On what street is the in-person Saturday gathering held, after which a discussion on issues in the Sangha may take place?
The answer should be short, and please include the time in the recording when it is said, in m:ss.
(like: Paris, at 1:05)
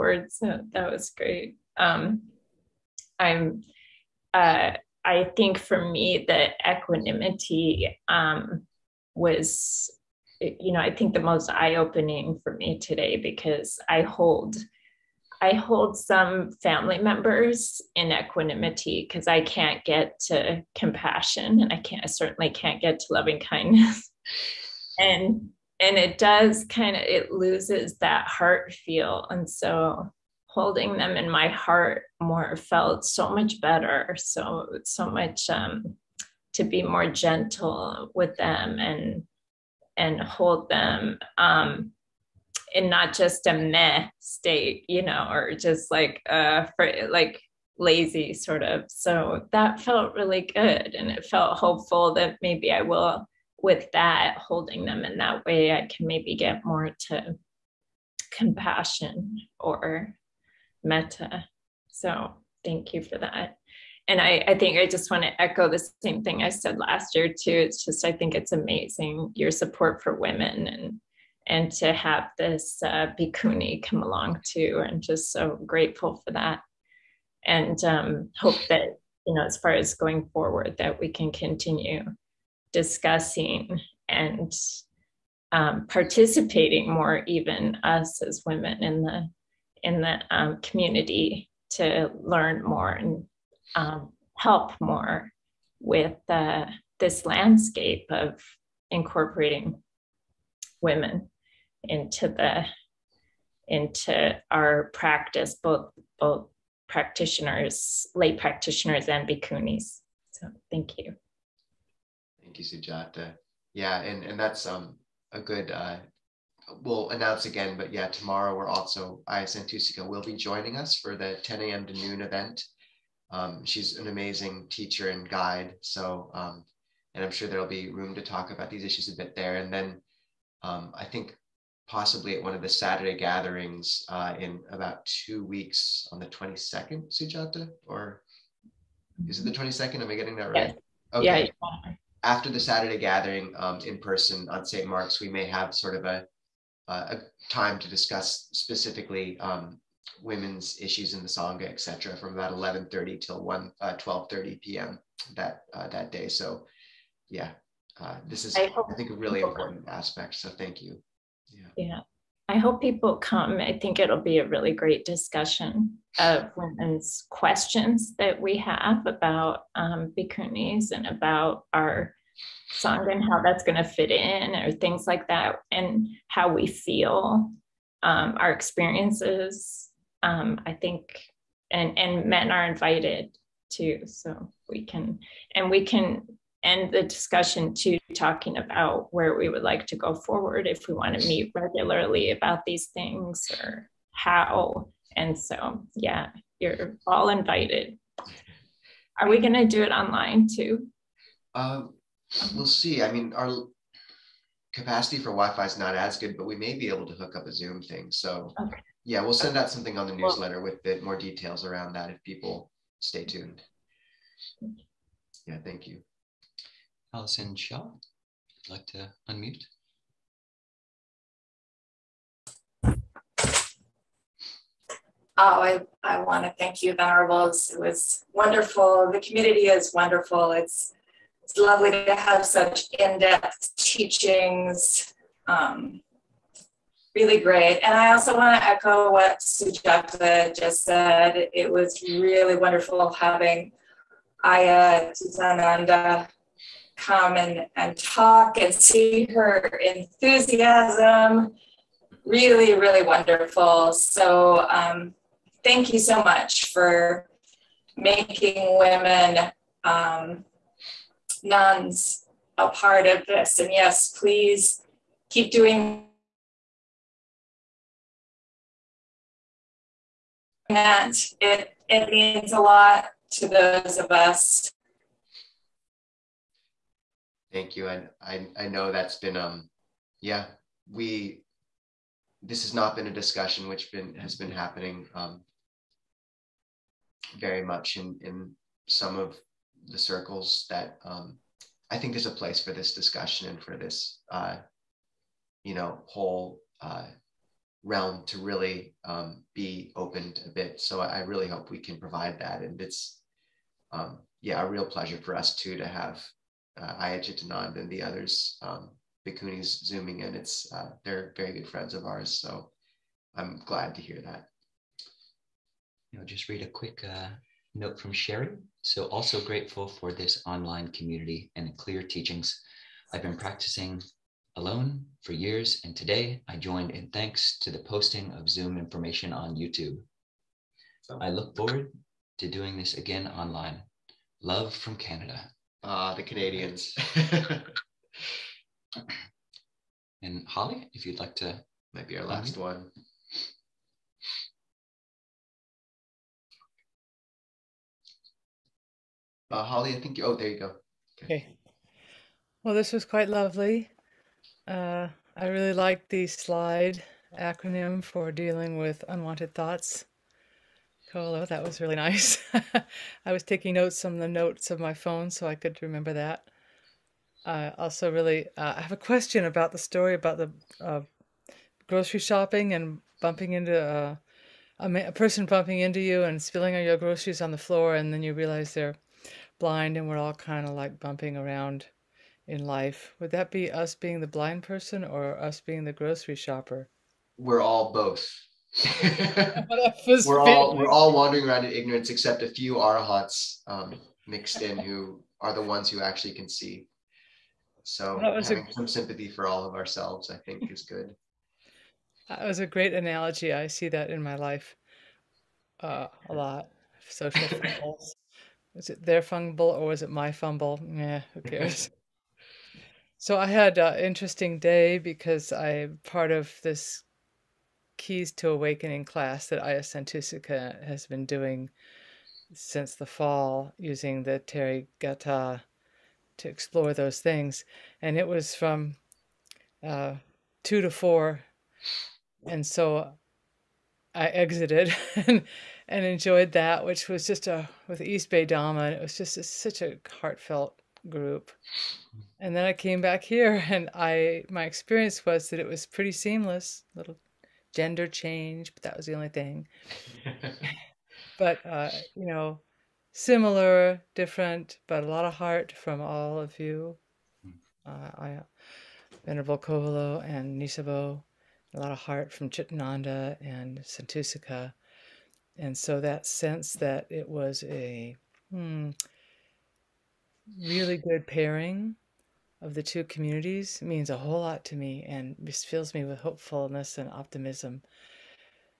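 St. Mark's, at 2:24.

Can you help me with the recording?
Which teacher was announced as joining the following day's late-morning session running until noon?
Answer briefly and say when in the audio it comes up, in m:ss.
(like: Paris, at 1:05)
Ayya Santussika, at 1:59.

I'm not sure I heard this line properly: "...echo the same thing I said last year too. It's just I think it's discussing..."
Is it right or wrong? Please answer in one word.
wrong.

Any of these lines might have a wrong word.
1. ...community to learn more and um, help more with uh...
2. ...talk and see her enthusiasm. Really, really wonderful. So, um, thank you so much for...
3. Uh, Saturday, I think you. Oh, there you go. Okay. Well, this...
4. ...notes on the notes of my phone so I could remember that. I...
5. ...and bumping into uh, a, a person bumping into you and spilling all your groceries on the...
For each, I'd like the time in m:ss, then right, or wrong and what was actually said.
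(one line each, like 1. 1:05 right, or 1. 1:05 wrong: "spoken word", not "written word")
1. 1:30 right
2. 4:07 right
3. 5:49 wrong: "Holly", not "Saturday"
4. 6:03 right
5. 6:12 right.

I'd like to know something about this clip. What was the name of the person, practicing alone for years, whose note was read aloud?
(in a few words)
Sherry.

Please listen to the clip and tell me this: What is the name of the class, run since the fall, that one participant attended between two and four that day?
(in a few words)
Keys to Awakening.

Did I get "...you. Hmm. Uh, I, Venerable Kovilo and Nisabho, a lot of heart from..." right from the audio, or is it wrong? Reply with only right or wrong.
right.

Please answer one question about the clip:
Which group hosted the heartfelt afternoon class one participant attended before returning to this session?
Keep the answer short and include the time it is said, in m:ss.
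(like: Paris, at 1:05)
East Bay Dharma, at 7:17.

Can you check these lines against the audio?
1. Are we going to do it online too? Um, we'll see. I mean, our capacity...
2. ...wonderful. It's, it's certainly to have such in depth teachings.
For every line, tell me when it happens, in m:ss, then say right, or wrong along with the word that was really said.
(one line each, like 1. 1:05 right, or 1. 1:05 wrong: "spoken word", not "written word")
1. 3:19 right
2. 3:49 wrong: "lovely", not "certainly".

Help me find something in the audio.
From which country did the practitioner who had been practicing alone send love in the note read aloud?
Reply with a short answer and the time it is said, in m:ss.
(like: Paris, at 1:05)
Canada, at 5:34.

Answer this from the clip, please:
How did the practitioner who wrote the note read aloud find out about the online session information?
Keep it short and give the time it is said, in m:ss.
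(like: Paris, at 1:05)
YouTube, at 5:29.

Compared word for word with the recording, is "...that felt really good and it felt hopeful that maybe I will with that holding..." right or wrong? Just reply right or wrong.
right.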